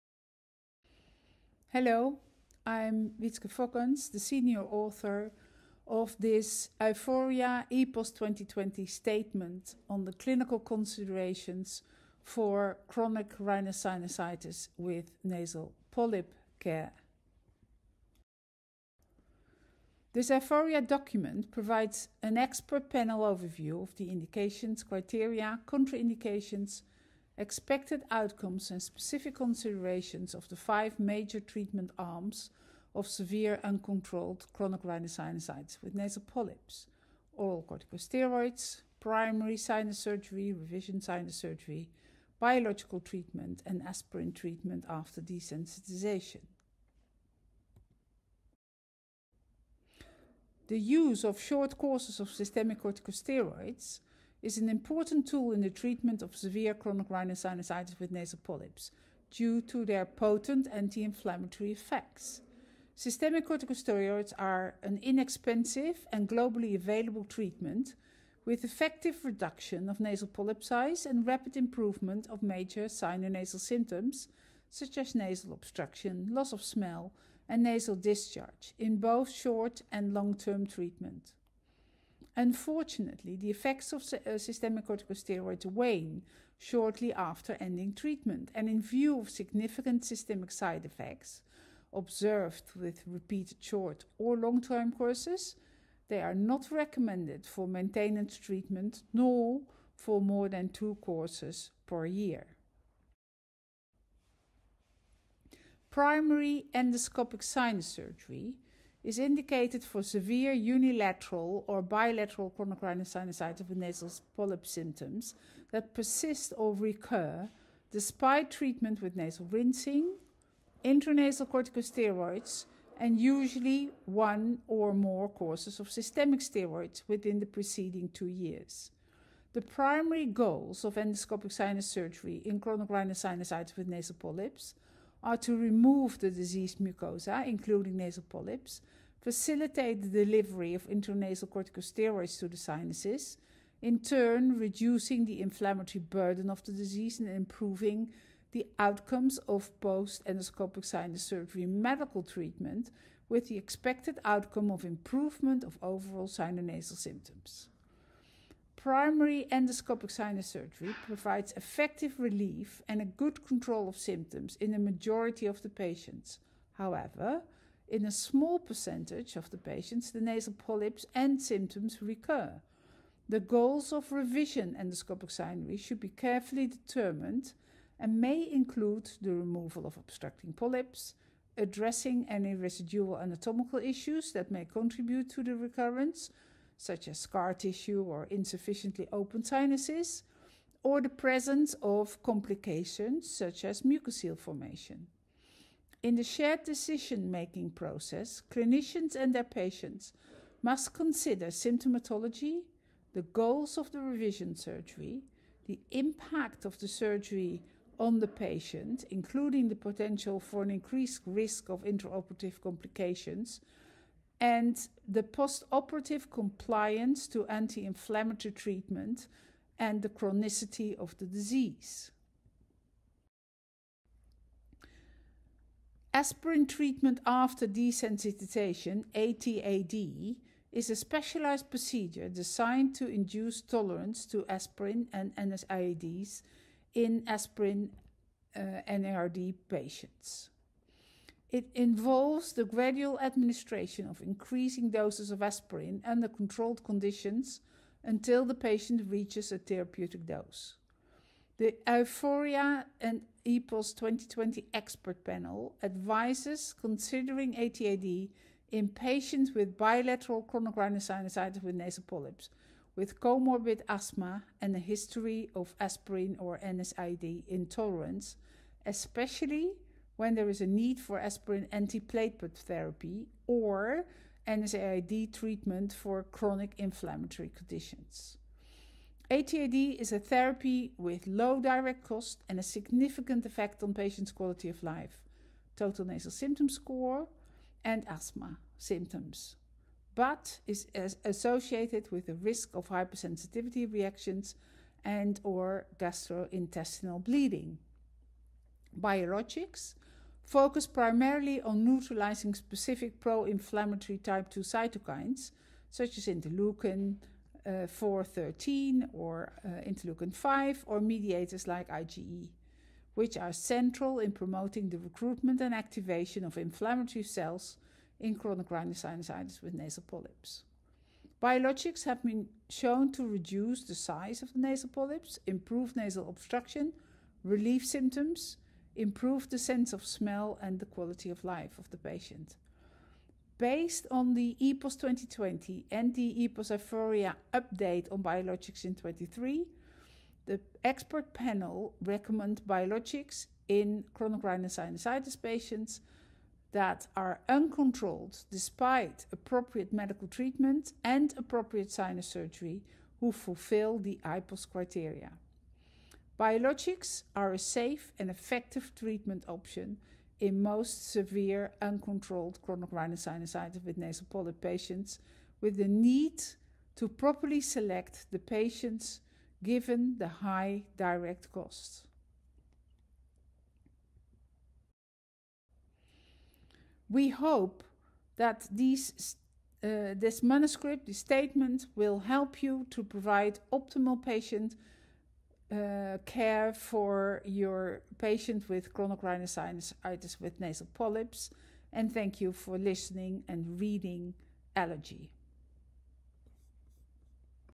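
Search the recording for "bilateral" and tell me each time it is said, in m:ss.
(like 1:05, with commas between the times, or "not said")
1:51, 4:19.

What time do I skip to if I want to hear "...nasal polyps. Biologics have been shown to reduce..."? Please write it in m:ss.
5:19.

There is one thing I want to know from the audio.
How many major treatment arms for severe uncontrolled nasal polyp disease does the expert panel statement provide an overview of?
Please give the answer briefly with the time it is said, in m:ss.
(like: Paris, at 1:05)
5, at 0:30.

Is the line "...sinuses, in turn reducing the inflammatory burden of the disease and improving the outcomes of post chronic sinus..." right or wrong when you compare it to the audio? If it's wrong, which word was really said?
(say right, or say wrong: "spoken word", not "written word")
wrong: "endoscopic", not "chronic".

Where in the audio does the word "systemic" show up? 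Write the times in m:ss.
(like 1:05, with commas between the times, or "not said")
0:52, 1:02, 1:24, 1:30, 2:05.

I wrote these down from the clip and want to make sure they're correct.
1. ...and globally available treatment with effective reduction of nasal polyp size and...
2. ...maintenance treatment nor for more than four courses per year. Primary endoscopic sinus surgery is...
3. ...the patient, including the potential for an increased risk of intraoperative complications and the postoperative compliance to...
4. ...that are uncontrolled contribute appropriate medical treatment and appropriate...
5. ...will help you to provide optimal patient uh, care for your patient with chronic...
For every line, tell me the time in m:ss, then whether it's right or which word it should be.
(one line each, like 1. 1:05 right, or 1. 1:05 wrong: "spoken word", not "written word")
1. 1:06 right
2. 1:37 wrong: "two", not "four"
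3. 3:28 right
4. 5:46 wrong: "despite", not "contribute"
5. 6:21 right.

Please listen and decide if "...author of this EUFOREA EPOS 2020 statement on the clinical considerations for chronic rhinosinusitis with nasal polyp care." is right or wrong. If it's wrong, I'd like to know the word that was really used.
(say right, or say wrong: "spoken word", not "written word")
right.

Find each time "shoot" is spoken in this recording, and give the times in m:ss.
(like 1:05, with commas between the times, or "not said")
not said.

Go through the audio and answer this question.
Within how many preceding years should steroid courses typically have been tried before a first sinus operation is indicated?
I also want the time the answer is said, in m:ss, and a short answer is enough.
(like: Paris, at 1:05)
2, at 2:08.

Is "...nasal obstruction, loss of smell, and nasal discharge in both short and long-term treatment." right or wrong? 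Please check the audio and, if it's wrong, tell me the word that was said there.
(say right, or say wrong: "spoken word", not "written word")
right.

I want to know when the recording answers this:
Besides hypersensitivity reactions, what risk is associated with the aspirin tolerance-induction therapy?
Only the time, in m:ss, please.
4:55.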